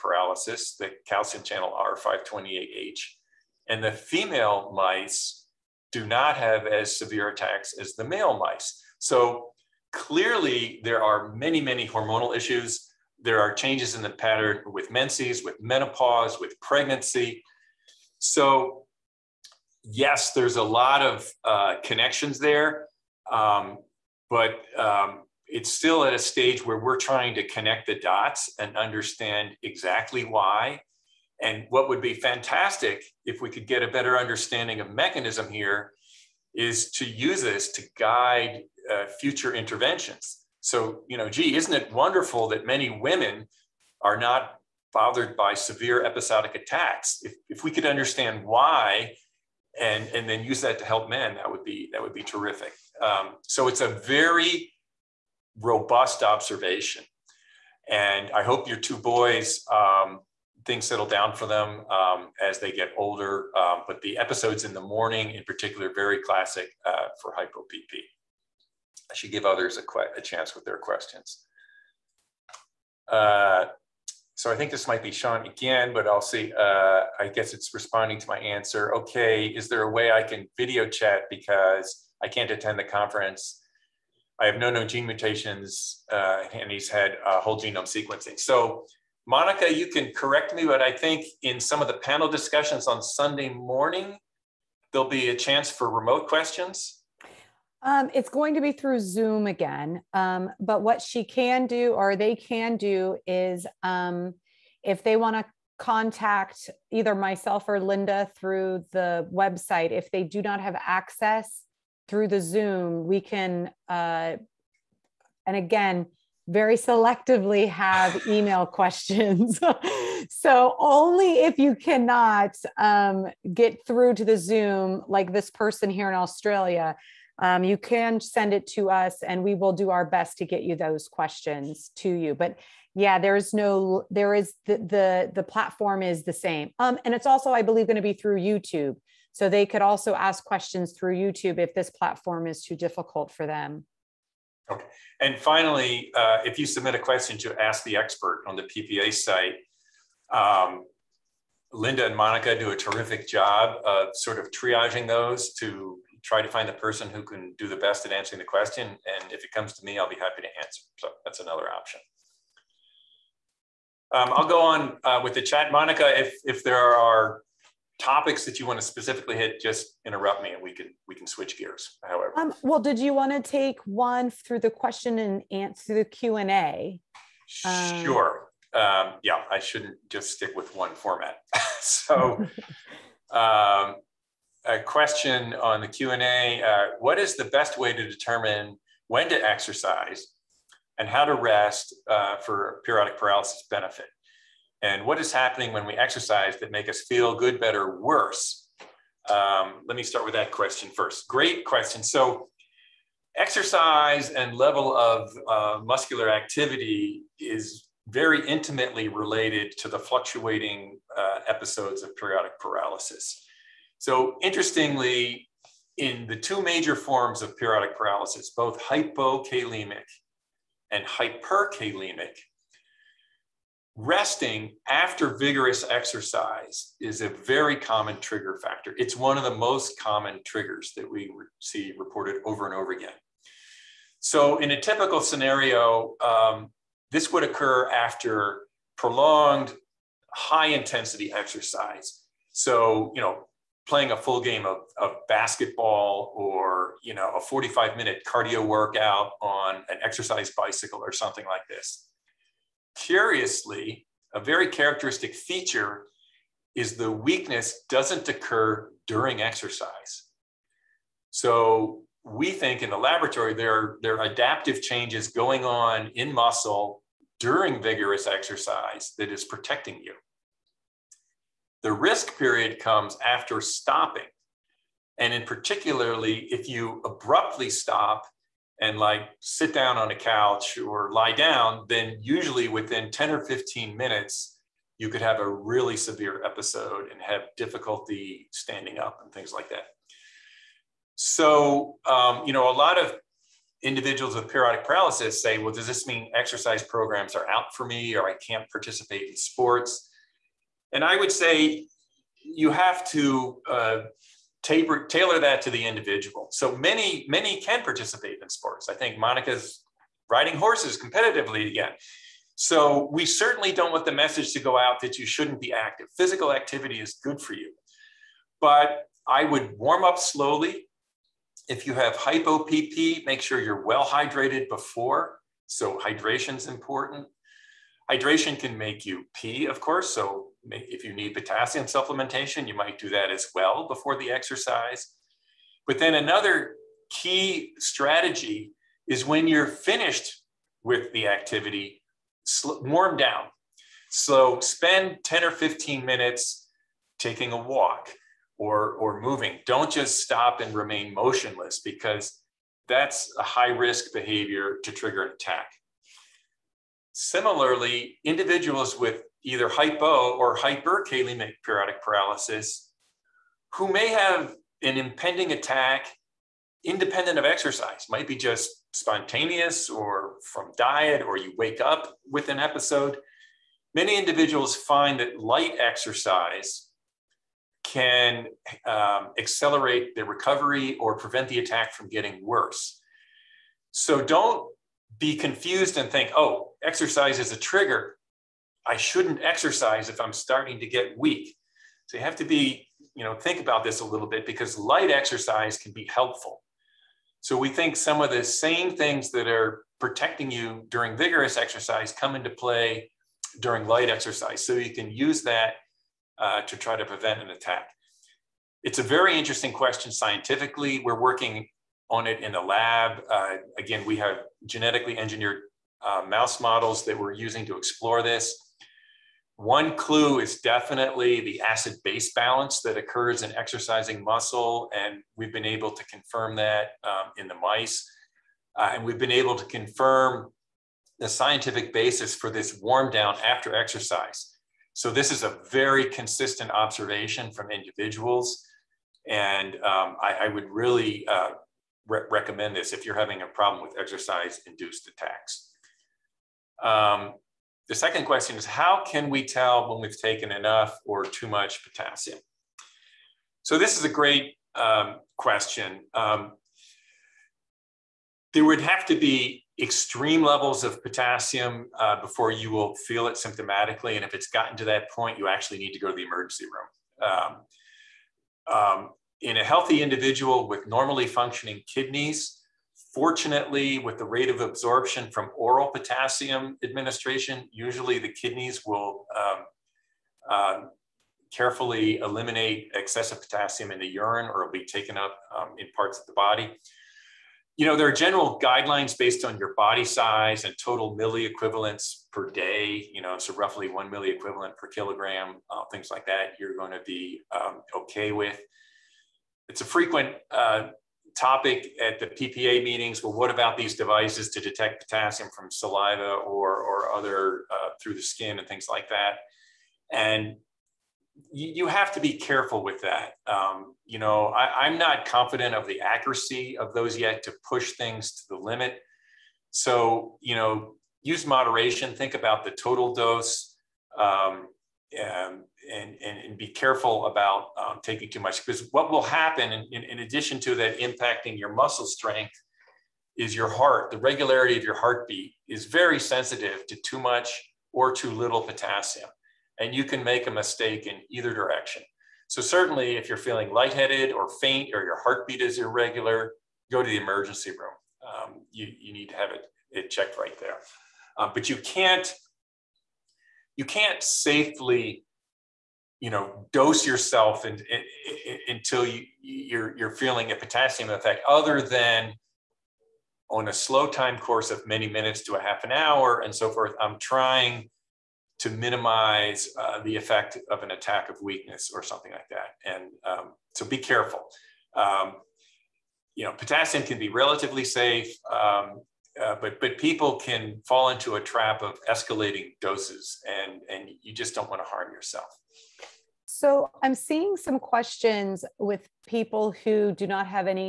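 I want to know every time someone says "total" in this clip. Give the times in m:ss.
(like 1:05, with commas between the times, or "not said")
8:10, 8:42.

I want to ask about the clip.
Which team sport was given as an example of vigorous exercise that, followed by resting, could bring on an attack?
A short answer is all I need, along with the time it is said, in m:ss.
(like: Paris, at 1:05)
Basketball, at 4:05.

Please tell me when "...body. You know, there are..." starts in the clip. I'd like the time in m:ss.
8:06.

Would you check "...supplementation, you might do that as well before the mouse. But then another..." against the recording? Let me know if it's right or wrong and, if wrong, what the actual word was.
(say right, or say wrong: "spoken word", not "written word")
wrong: "exercise", not "mouse".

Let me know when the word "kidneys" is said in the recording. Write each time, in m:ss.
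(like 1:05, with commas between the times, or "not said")
7:51, 7:58.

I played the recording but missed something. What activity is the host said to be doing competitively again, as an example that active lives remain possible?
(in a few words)
Riding horses.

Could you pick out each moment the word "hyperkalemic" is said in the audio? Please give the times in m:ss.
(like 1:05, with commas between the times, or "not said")
3:41, 6:00.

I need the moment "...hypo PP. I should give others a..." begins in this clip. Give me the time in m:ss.
1:07.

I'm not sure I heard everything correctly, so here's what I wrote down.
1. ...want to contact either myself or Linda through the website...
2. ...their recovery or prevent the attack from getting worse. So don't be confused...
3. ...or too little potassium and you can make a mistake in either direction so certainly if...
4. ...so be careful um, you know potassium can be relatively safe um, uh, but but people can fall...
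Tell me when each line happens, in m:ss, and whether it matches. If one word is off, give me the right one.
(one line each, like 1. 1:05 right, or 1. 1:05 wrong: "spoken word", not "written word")
1. 1:45 right
2. 6:20 right
3. 8:57 right
4. 9:33 right.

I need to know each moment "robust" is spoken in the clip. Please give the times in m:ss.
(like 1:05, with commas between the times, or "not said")
0:55.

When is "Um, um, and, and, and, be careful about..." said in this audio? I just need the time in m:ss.
8:44.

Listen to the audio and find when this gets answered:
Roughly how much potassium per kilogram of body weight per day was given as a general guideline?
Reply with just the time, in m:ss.
8:13.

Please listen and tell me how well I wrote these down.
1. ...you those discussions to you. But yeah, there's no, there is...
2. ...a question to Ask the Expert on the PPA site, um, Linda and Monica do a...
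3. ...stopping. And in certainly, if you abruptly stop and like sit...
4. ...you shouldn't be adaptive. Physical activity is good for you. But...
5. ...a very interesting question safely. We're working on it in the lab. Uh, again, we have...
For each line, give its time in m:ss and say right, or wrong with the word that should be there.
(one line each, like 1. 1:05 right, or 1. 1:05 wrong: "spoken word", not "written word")
1. 2:10 wrong: "questions", not "discussions"
2. 2:26 right
3. 4:33 wrong: "particularly", not "certainly"
4. 5:15 wrong: "active", not "adaptive"
5. 6:48 wrong: "scientifically", not "safely".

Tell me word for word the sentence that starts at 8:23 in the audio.
Well, what about these devices to detect potassium from saliva or, or other uh, through the skin and things like that?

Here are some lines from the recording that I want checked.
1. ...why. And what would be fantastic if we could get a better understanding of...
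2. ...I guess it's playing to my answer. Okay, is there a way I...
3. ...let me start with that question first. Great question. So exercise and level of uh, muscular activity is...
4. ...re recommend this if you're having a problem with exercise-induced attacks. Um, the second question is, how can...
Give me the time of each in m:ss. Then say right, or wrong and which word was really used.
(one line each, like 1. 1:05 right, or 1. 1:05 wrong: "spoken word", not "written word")
1. 0:30 right
2. 1:17 wrong: "responding", not "playing"
3. 3:19 right
4. 7:22 right.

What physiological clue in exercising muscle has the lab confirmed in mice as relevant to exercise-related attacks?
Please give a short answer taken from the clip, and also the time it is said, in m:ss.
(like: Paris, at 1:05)
Acid base balance, at 7:01.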